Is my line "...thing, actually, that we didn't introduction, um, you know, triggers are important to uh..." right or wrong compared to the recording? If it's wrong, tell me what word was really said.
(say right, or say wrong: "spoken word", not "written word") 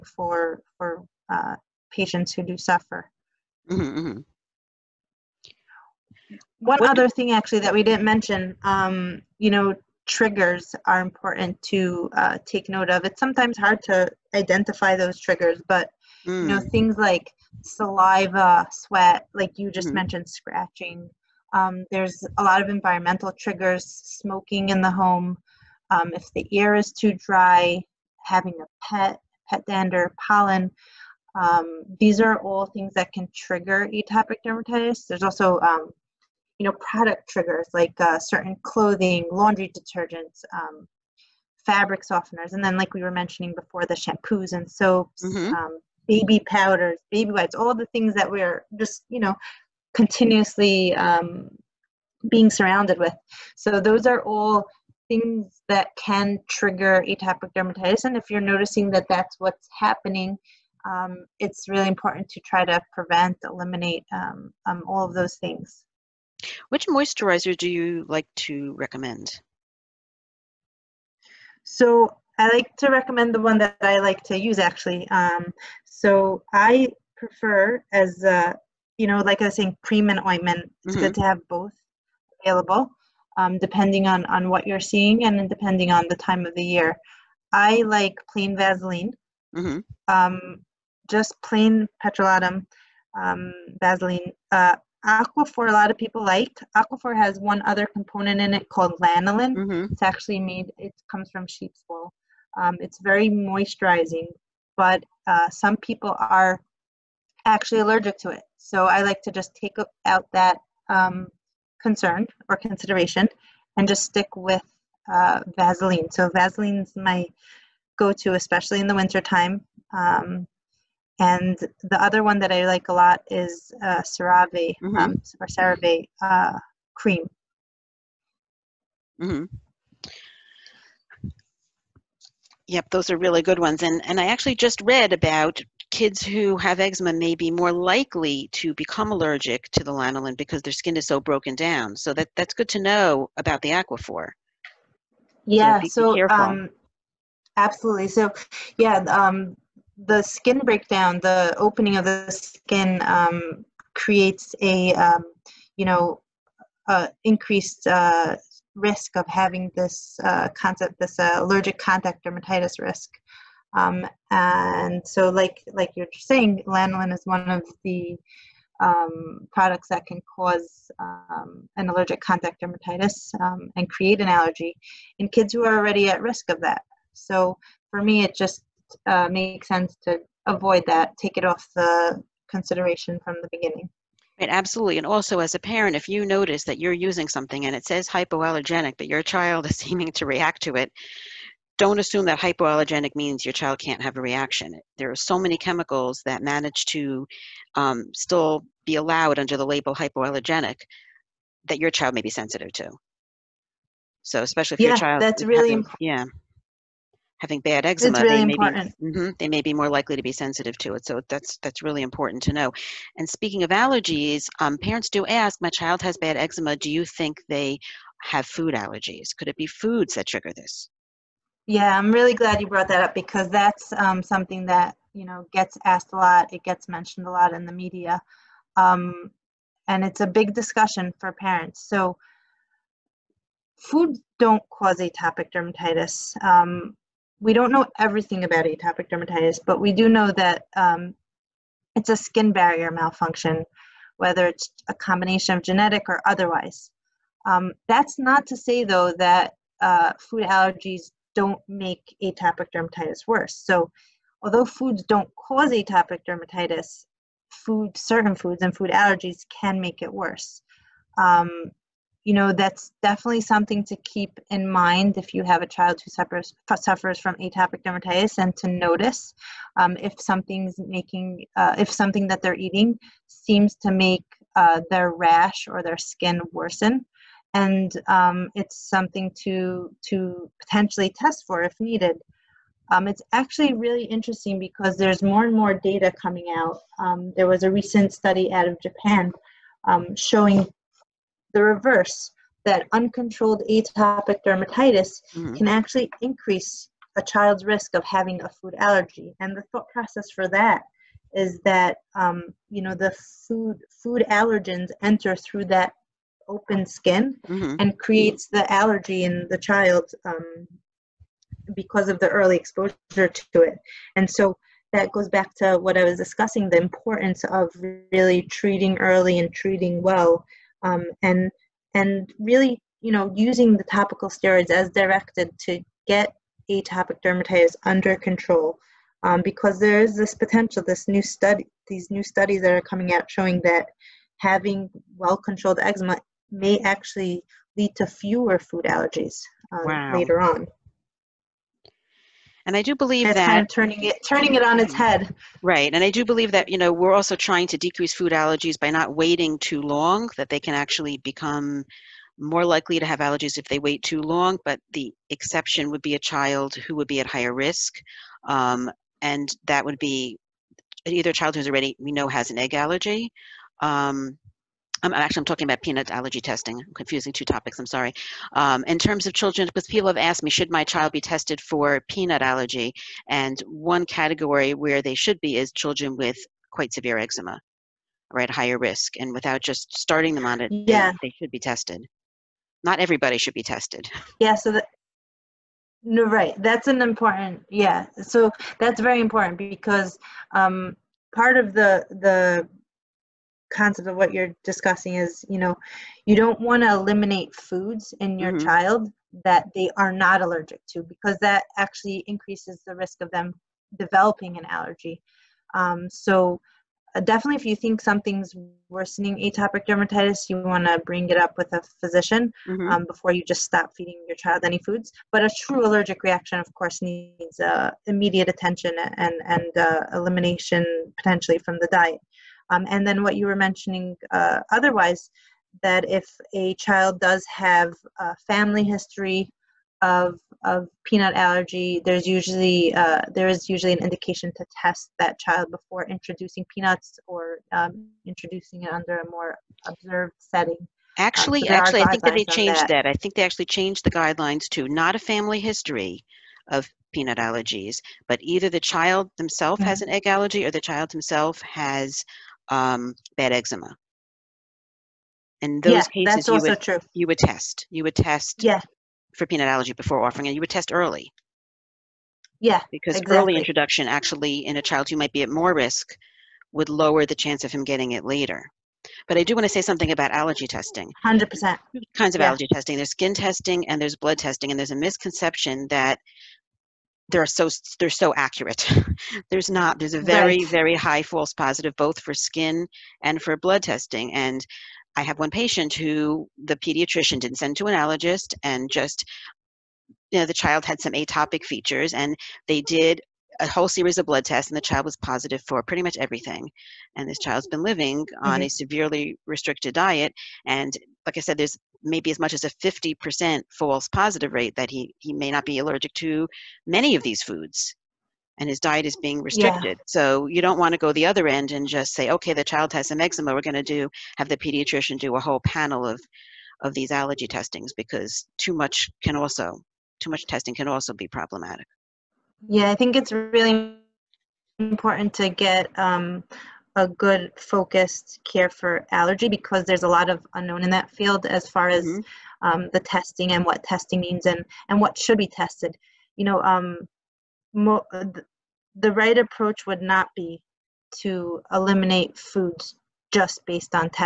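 wrong: "mention", not "introduction".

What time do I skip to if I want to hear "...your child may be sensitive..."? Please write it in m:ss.
3:21.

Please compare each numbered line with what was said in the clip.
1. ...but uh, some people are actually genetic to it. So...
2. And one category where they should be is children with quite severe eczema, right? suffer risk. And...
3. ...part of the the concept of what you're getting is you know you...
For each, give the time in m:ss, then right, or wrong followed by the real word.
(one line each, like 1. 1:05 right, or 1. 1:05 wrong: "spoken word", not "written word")
1. 1:44 wrong: "allergic", not "genetic"
2. 6:13 wrong: "higher", not "suffer"
3. 6:31 wrong: "discussing", not "getting".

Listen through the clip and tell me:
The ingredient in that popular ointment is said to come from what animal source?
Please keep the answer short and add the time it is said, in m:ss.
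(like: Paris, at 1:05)
sheep's wool, at 1:41.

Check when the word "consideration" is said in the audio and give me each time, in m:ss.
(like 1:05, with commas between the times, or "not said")
1:52, 3:02.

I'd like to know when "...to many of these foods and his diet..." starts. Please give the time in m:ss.
8:26.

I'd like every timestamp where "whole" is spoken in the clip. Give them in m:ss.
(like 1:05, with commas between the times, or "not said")
8:13, 8:35.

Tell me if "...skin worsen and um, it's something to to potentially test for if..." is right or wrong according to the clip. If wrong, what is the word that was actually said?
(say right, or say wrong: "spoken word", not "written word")
right.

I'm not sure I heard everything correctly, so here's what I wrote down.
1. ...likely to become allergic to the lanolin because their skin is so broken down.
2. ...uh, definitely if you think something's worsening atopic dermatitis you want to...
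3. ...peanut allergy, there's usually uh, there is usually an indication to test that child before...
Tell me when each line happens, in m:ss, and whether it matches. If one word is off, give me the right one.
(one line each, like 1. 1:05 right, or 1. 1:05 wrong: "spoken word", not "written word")
1. 2:17 right
2. 6:47 right
3. 7:11 right.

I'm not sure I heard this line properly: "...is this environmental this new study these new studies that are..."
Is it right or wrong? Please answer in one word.
wrong.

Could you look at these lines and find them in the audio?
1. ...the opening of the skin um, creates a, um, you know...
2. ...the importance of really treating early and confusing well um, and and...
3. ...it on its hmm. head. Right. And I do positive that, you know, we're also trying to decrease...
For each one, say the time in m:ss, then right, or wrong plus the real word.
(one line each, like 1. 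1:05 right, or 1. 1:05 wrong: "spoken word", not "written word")
1. 2:31 right
2. 5:16 wrong: "treating", not "confusing"
3. 5:44 wrong: "believe", not "positive".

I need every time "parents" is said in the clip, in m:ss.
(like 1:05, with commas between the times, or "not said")
3:05, 3:34, 3:51.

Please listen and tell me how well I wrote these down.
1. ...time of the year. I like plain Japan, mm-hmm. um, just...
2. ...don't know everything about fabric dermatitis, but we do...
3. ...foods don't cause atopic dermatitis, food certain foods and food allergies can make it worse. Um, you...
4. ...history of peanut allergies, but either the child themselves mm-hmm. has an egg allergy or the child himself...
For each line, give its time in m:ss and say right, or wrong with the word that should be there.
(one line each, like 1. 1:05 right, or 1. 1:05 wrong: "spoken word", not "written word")
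1. 1:26 wrong: "Vaseline", not "Japan"
2. 3:57 wrong: "atopic", not "fabric"
3. 4:14 right
4. 7:25 right.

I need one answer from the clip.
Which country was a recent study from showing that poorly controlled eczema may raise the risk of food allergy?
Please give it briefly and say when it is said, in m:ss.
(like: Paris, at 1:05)
Japan, at 4:48.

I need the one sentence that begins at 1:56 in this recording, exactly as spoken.
So Vaseline's my go-to, especially in the wintertime.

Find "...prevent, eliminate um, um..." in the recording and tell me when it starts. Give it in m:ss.
1:02.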